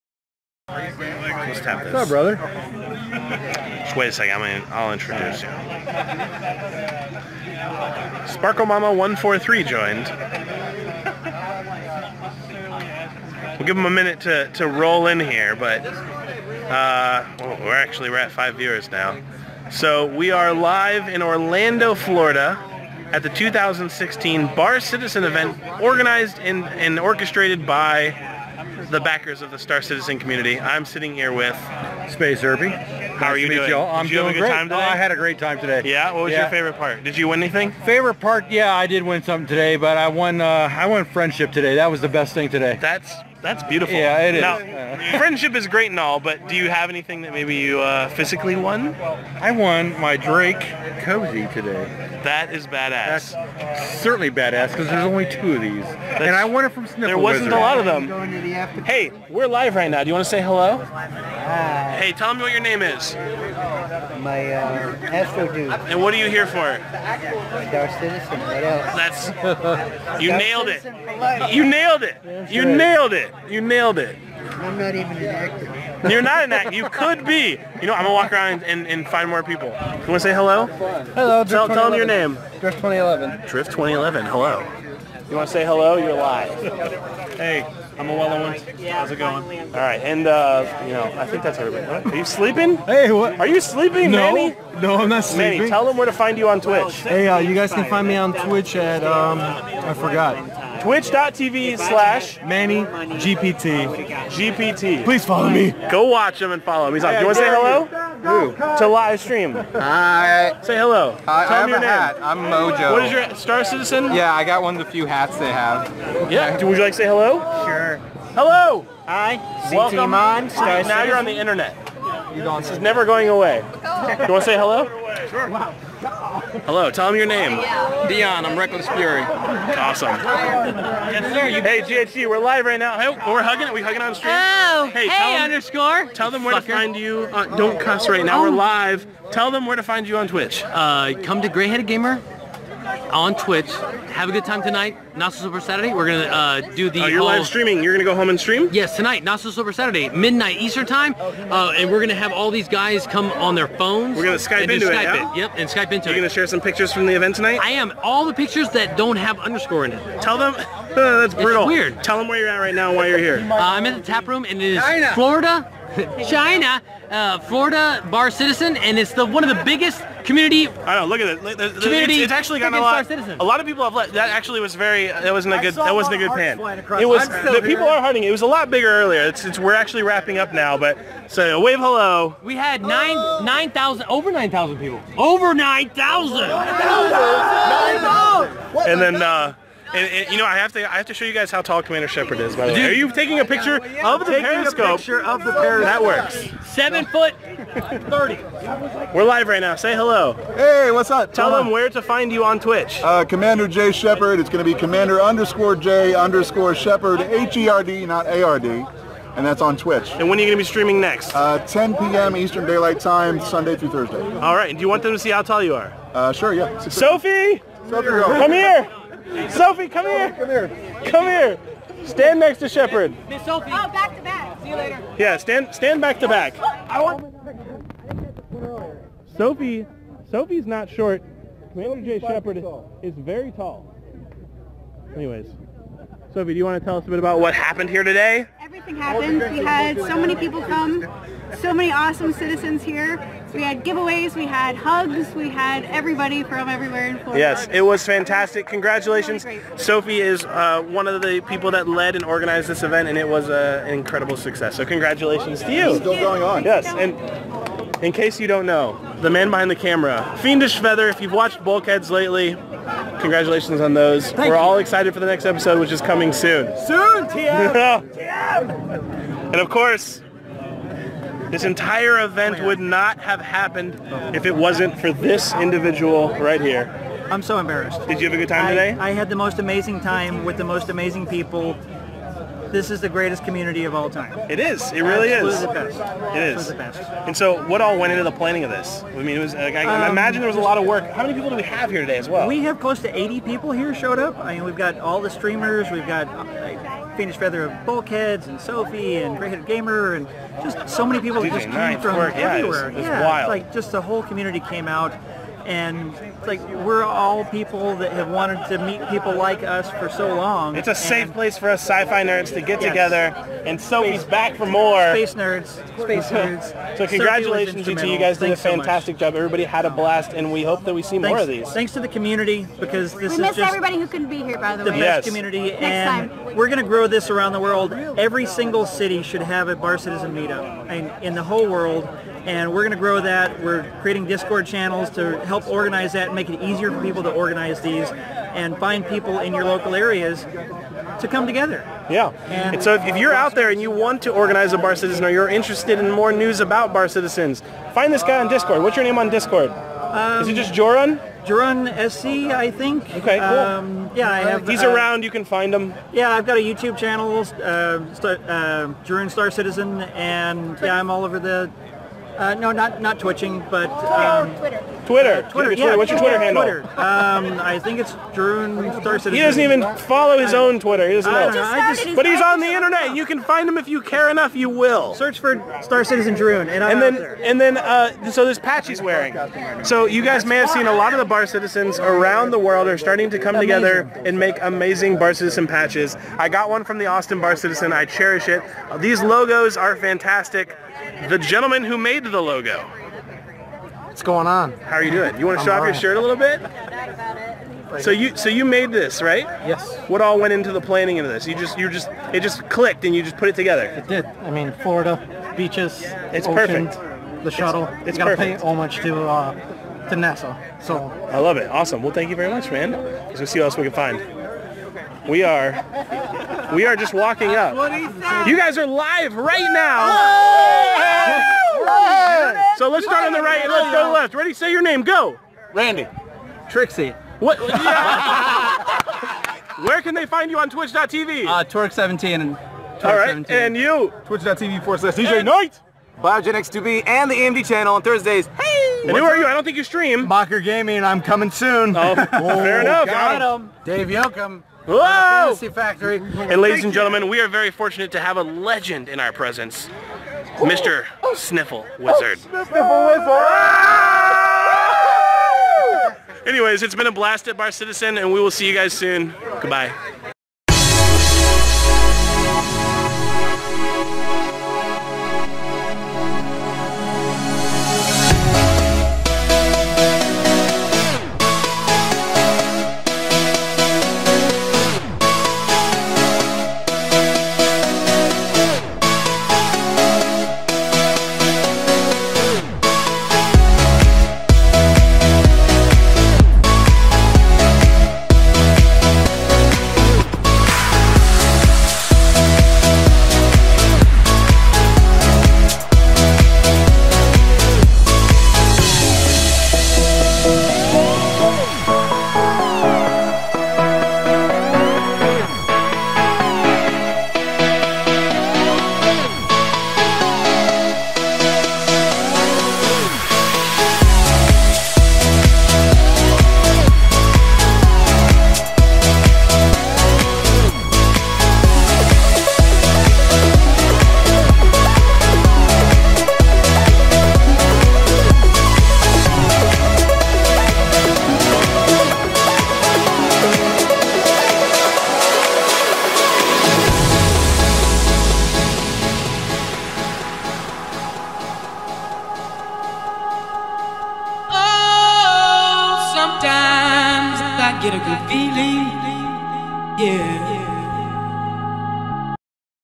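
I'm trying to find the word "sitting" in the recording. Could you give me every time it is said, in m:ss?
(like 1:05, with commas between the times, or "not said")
0:30.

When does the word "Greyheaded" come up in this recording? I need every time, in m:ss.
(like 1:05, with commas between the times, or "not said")
2:21, 4:59.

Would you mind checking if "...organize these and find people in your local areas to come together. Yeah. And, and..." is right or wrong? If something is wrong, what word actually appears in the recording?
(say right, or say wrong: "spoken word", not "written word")
right.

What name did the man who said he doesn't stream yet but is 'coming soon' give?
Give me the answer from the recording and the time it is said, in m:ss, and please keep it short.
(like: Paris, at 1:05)
Mocker Gaming, at 7:20.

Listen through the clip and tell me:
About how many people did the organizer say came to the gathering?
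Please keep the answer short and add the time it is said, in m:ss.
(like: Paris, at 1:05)
close to 80, at 4:52.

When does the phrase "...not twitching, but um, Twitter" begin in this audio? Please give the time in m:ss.
6:03.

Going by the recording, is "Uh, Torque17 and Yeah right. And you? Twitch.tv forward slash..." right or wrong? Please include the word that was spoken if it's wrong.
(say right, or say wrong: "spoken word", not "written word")
wrong: "All", not "Yeah".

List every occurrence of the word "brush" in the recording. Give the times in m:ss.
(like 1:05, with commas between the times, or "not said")
not said.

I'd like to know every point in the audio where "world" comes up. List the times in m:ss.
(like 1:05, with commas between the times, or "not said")
5:27, 5:31, 6:22.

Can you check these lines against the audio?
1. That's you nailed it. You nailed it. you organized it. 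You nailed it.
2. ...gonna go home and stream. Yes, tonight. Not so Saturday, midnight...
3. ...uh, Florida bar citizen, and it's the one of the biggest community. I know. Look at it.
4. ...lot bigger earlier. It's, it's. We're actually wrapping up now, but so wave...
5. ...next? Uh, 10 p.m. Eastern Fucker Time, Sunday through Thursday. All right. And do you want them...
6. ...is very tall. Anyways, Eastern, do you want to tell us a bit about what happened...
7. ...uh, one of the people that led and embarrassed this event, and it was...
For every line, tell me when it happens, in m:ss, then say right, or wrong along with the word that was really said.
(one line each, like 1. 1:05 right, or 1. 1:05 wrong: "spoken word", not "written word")
1. 1:09 wrong: "nailed", not "organized"
2. 2:27 right
3. 2:47 right
4. 2:58 right
5. 3:30 wrong: "Daylight", not "Fucker"
6. 3:53 wrong: "Sophie", not "Eastern"
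7. 4:10 wrong: "organized", not "embarrassed".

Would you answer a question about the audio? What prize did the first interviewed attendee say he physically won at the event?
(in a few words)
Drake cozy.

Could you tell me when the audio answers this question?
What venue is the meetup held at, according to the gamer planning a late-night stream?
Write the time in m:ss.
2:44.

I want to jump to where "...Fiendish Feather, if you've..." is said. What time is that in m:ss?
4:20.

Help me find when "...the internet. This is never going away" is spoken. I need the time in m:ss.
2:01.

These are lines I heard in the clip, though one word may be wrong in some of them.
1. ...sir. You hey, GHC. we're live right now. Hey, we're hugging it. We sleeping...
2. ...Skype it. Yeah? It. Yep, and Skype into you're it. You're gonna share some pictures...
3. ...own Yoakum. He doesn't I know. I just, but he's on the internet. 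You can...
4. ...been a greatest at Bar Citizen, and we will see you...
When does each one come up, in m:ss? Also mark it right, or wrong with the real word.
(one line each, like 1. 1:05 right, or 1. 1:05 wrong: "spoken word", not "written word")
1. 2:11 wrong: "hugging", not "sleeping"
2. 2:34 right
3. 6:10 wrong: "Twitter", not "Yoakum"
4. 7:36 wrong: "blast", not "greatest".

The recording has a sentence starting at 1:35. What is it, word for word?
Manny, tell them where to find you on Twitch.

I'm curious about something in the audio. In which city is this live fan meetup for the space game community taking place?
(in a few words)
Orlando, Florida.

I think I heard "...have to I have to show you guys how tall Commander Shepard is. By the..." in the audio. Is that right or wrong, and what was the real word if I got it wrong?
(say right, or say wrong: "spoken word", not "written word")
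right.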